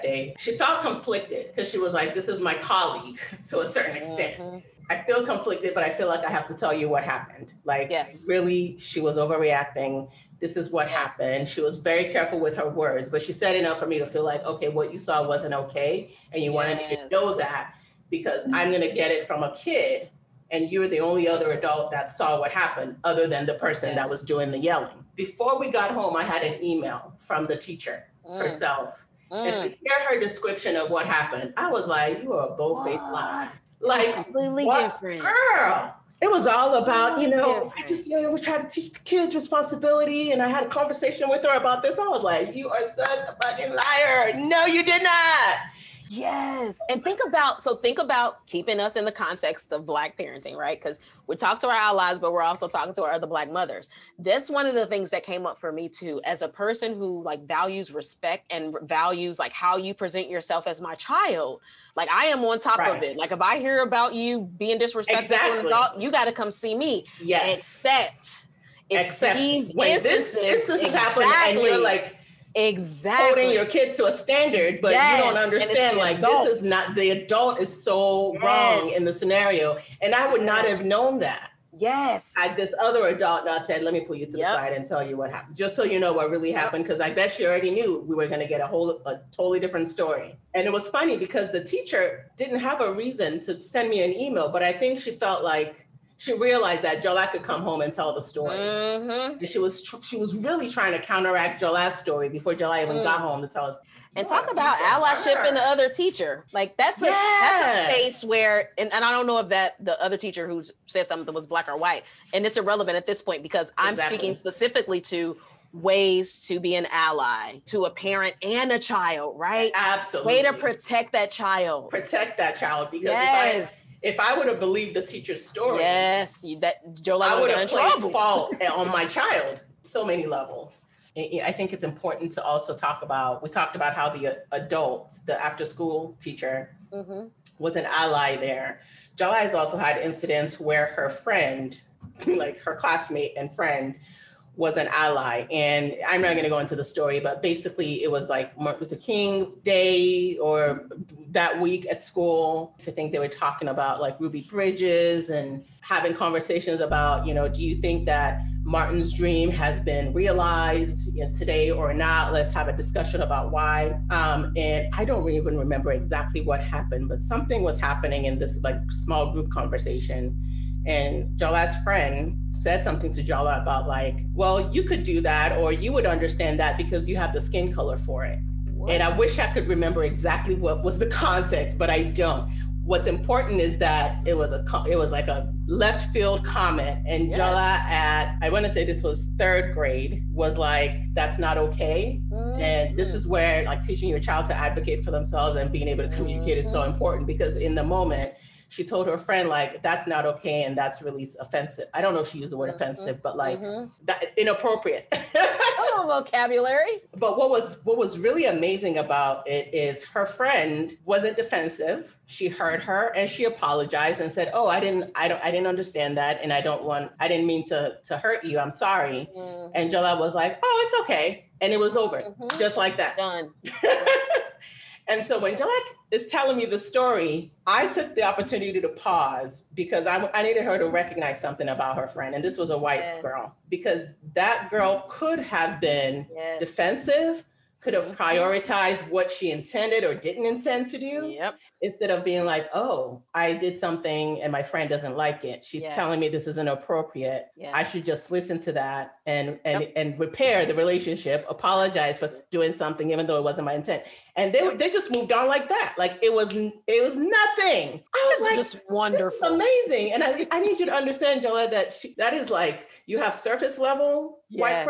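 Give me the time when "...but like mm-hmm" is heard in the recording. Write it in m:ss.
3:23.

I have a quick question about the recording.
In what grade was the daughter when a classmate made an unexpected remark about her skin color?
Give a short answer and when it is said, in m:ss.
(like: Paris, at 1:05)
Third grade, at 3:09.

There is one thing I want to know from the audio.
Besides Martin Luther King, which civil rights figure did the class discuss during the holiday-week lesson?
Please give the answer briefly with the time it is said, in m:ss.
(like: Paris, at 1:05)
Ruby Bridges, at 2:34.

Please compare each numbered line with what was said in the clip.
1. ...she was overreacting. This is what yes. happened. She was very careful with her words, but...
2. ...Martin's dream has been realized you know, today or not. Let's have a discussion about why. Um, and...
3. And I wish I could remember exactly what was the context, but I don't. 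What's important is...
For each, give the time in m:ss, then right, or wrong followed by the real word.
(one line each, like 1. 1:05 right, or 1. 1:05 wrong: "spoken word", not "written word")
1. 0:08 right
2. 2:38 right
3. 2:58 right.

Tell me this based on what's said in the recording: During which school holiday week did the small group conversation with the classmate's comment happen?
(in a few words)
Martin Luther King Day.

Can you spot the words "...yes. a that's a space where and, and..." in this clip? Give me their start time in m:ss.
1:47.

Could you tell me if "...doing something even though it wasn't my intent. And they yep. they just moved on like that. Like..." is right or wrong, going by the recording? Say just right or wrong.
right.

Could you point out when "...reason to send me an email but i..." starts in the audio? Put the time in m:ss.
1:32.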